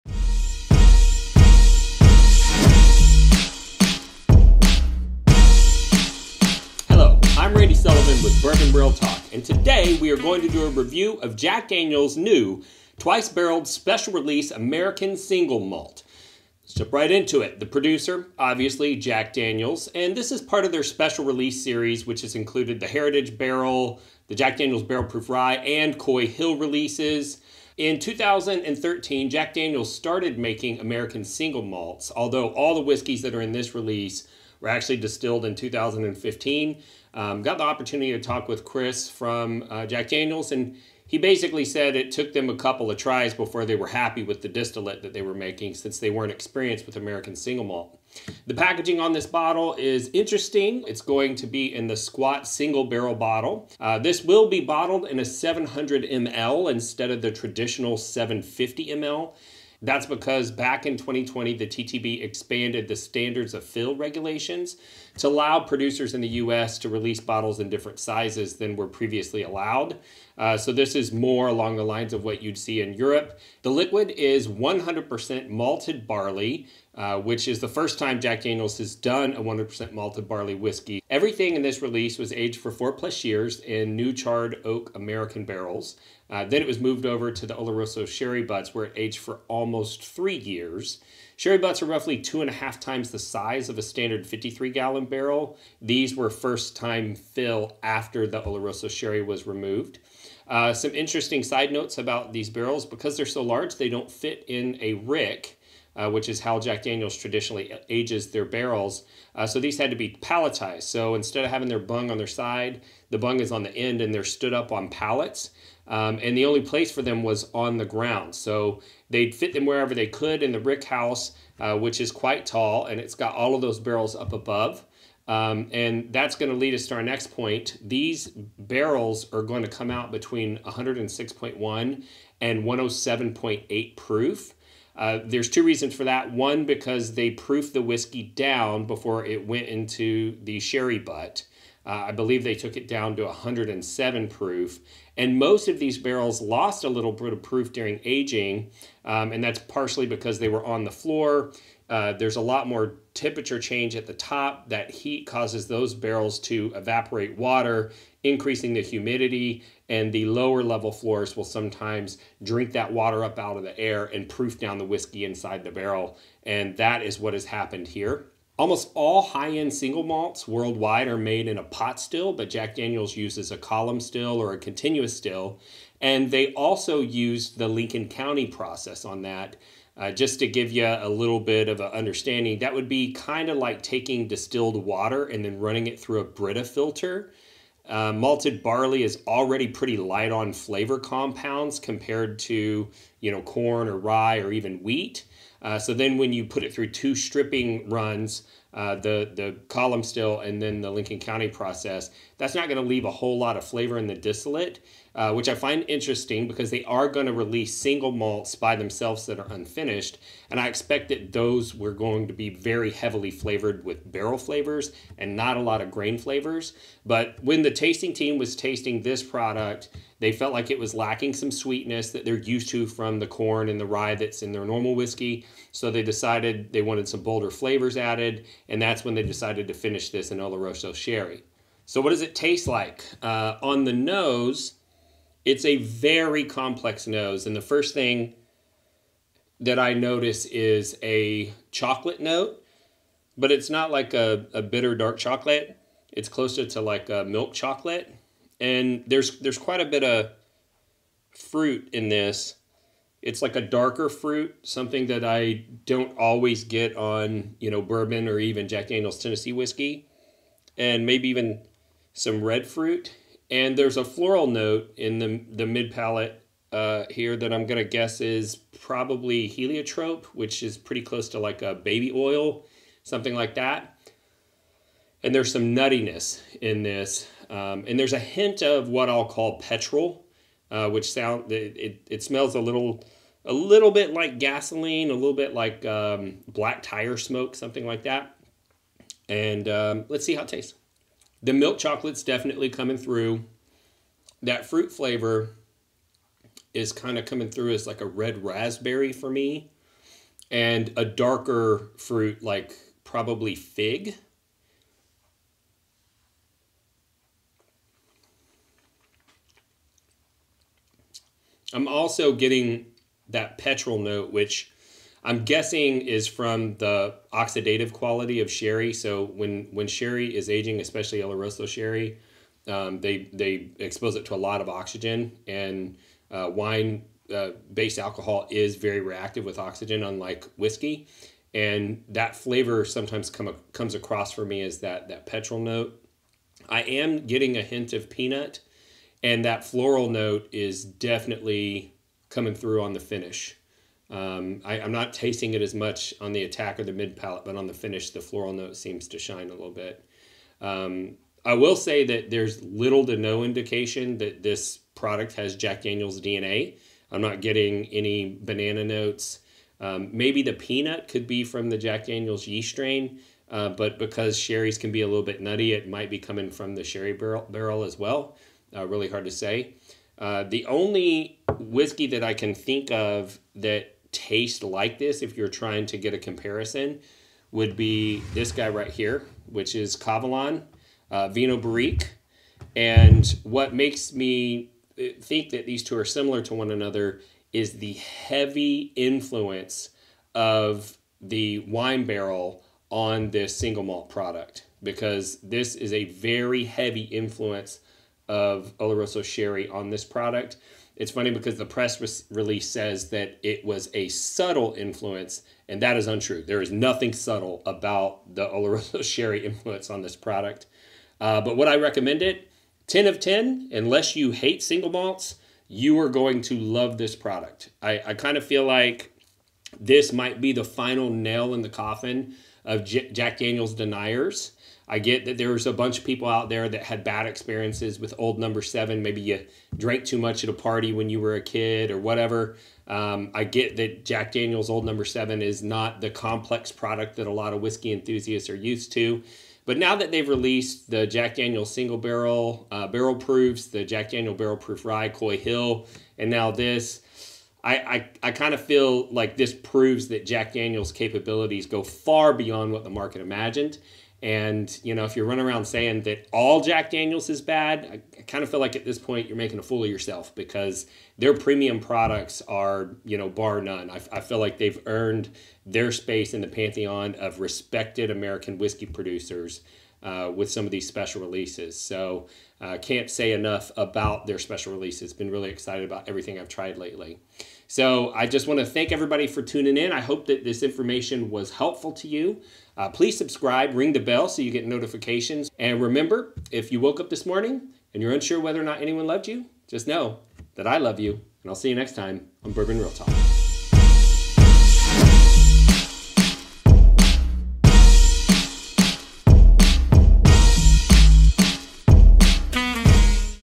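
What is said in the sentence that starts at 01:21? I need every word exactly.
Everything in this release was aged for four plus years in new charred oak American barrels.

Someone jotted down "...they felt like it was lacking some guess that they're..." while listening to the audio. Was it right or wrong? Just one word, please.
wrong.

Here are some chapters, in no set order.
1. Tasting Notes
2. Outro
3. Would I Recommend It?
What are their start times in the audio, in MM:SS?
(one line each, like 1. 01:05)
1. 03:51
2. 07:57
3. 06:51.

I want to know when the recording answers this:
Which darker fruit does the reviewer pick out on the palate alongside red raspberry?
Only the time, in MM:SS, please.
05:03.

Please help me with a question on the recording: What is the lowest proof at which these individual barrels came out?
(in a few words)
106.1.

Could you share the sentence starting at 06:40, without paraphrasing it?
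It's funny because the press re release says that it was a subtle influence, and that is untrue.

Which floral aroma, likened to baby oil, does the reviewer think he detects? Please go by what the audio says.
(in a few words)
heliotrope.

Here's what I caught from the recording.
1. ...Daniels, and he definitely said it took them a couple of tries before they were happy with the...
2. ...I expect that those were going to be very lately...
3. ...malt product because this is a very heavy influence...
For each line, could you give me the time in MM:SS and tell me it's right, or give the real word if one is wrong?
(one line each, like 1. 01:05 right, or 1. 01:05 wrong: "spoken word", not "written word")
1. 00:40 wrong: "basically", not "definitely"
2. 03:30 wrong: "heavily", not "lately"
3. 06:33 right.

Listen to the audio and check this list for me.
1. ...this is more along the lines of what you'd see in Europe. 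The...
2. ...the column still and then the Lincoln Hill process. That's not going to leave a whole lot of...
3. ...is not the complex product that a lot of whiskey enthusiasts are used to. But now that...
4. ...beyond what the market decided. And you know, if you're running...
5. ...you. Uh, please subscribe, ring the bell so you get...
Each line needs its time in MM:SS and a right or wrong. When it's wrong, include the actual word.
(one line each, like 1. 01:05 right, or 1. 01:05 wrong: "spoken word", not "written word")
1. 01:10 right
2. 03:19 wrong: "County", not "Hill"
3. 07:15 right
4. 07:32 wrong: "imagined", not "decided"
5. 08:02 right.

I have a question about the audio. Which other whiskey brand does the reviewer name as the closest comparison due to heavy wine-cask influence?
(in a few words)
Kavalan.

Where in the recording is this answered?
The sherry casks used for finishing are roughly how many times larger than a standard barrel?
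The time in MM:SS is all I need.
01:32.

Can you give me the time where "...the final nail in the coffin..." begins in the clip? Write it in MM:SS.
07:00.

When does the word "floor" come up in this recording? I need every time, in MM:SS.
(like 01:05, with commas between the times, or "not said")
02:30, 02:40.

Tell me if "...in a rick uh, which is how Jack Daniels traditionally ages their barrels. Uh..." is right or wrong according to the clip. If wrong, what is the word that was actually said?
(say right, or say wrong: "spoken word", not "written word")
right.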